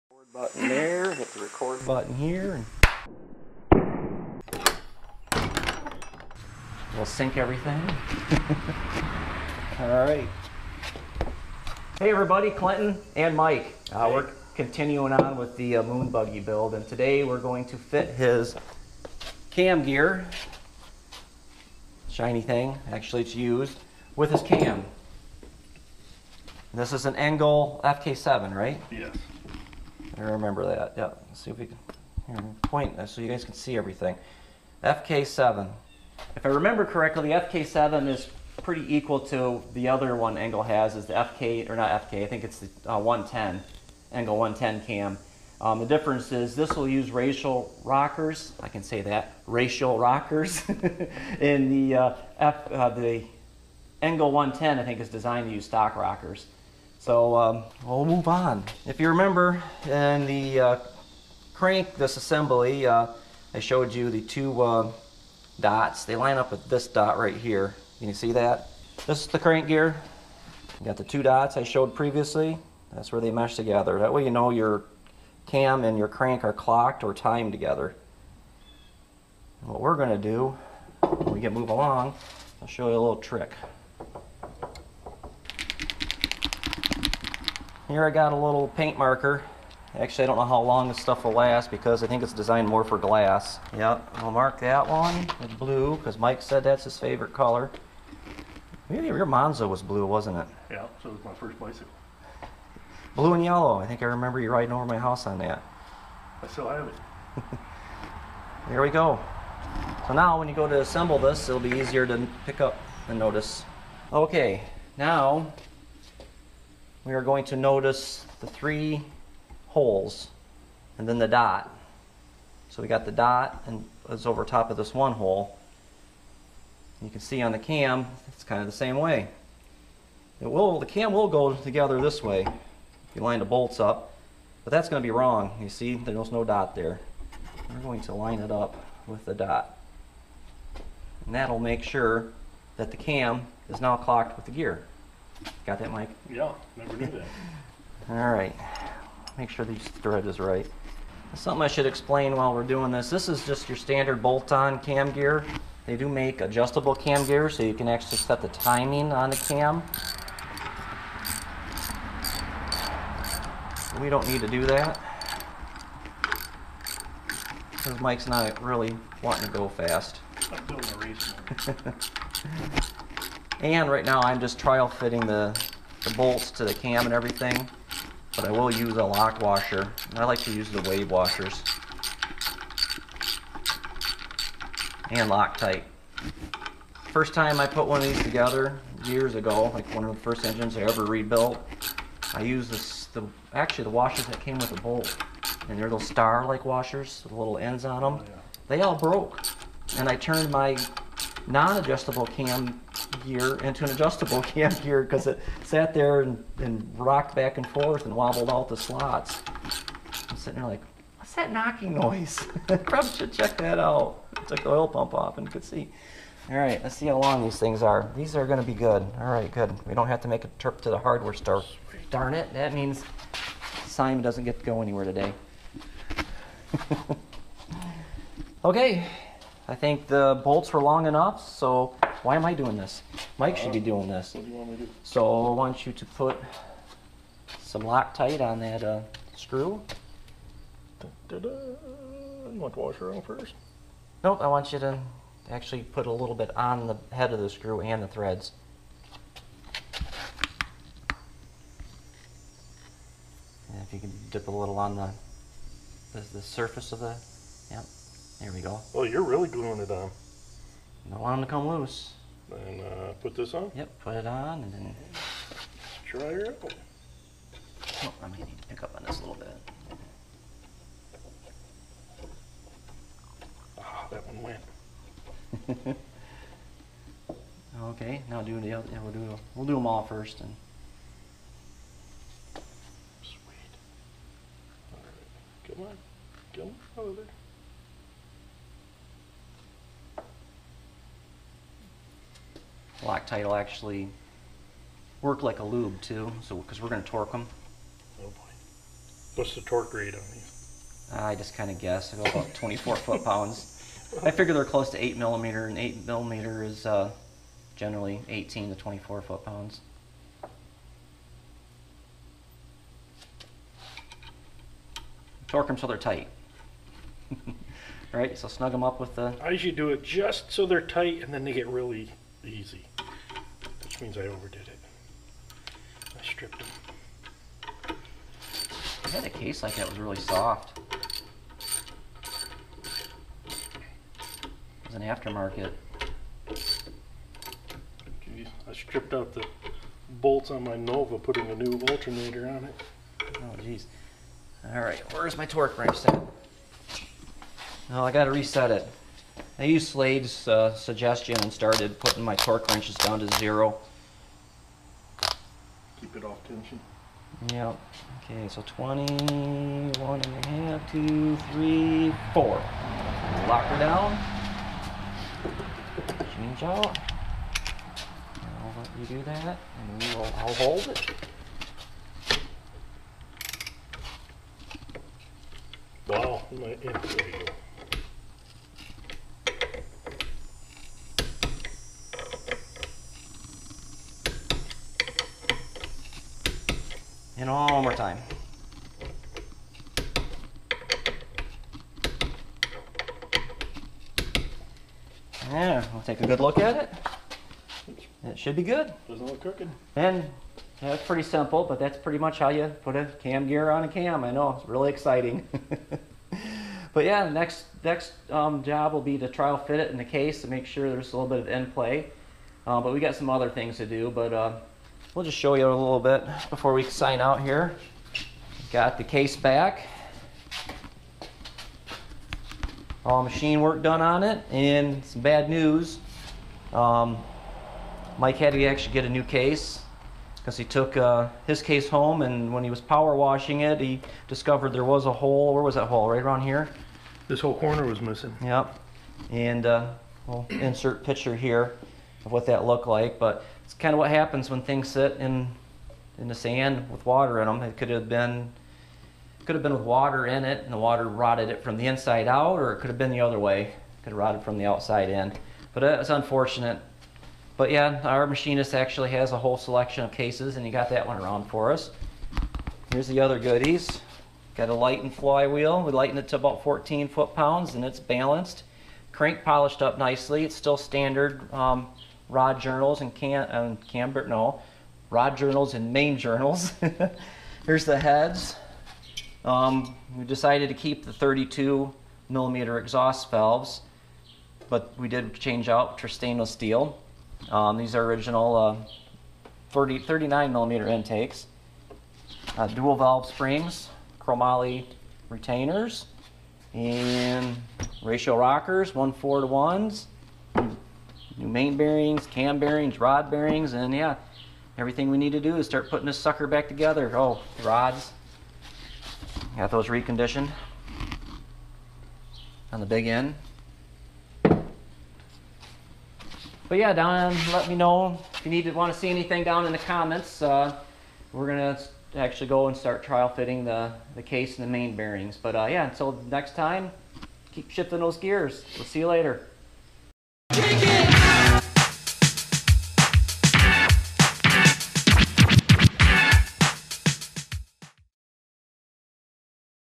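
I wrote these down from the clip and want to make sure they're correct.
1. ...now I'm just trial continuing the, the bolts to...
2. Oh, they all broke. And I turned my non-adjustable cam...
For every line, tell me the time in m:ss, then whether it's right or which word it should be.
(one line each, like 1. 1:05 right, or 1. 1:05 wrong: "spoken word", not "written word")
1. 2:54 wrong: "fitting", not "continuing"
2. 3:18 right.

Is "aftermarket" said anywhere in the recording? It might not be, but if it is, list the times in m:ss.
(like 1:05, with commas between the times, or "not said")
5:35.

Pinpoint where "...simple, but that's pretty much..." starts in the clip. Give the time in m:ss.
6:41.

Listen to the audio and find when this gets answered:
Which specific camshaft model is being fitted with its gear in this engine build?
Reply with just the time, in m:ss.
0:27.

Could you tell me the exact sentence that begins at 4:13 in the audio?
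And if you can dip a little on the, the, the surface of the, yep.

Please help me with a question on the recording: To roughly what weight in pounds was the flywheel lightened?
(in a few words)
14.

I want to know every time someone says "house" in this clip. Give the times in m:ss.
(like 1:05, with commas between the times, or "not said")
1:44.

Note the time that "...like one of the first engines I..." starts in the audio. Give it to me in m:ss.
3:09.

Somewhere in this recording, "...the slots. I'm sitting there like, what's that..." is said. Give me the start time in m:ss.
3:28.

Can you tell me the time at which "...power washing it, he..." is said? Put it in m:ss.
7:12.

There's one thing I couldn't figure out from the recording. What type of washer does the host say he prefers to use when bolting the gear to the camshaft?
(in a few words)
wave washers.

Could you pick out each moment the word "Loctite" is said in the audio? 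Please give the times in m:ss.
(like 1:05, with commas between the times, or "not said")
3:05, 3:57, 4:53.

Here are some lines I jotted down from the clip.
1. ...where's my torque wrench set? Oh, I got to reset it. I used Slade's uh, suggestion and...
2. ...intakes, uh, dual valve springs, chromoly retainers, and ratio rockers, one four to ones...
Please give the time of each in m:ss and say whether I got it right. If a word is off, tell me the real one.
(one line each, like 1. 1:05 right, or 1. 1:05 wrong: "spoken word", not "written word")
1. 5:45 right
2. 8:10 right.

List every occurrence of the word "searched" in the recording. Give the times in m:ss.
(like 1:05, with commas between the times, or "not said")
not said.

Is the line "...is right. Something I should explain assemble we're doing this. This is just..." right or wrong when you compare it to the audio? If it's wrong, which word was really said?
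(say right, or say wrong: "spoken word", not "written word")
wrong: "while", not "assemble".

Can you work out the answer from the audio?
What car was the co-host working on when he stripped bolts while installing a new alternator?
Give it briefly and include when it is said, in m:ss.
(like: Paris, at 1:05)
Nova, at 5:40.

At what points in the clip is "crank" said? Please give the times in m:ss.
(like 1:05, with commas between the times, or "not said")
1:01, 1:09, 1:16, 7:49.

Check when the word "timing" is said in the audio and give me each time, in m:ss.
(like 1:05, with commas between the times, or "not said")
2:38.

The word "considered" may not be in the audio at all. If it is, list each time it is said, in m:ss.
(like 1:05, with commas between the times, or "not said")
not said.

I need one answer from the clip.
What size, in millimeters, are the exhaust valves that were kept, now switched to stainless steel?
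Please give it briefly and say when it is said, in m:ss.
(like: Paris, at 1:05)
32 millimeter, at 8:01.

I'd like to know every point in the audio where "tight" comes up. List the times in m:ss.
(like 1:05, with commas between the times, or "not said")
5:15, 5:20.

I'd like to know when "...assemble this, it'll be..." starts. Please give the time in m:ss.
1:50.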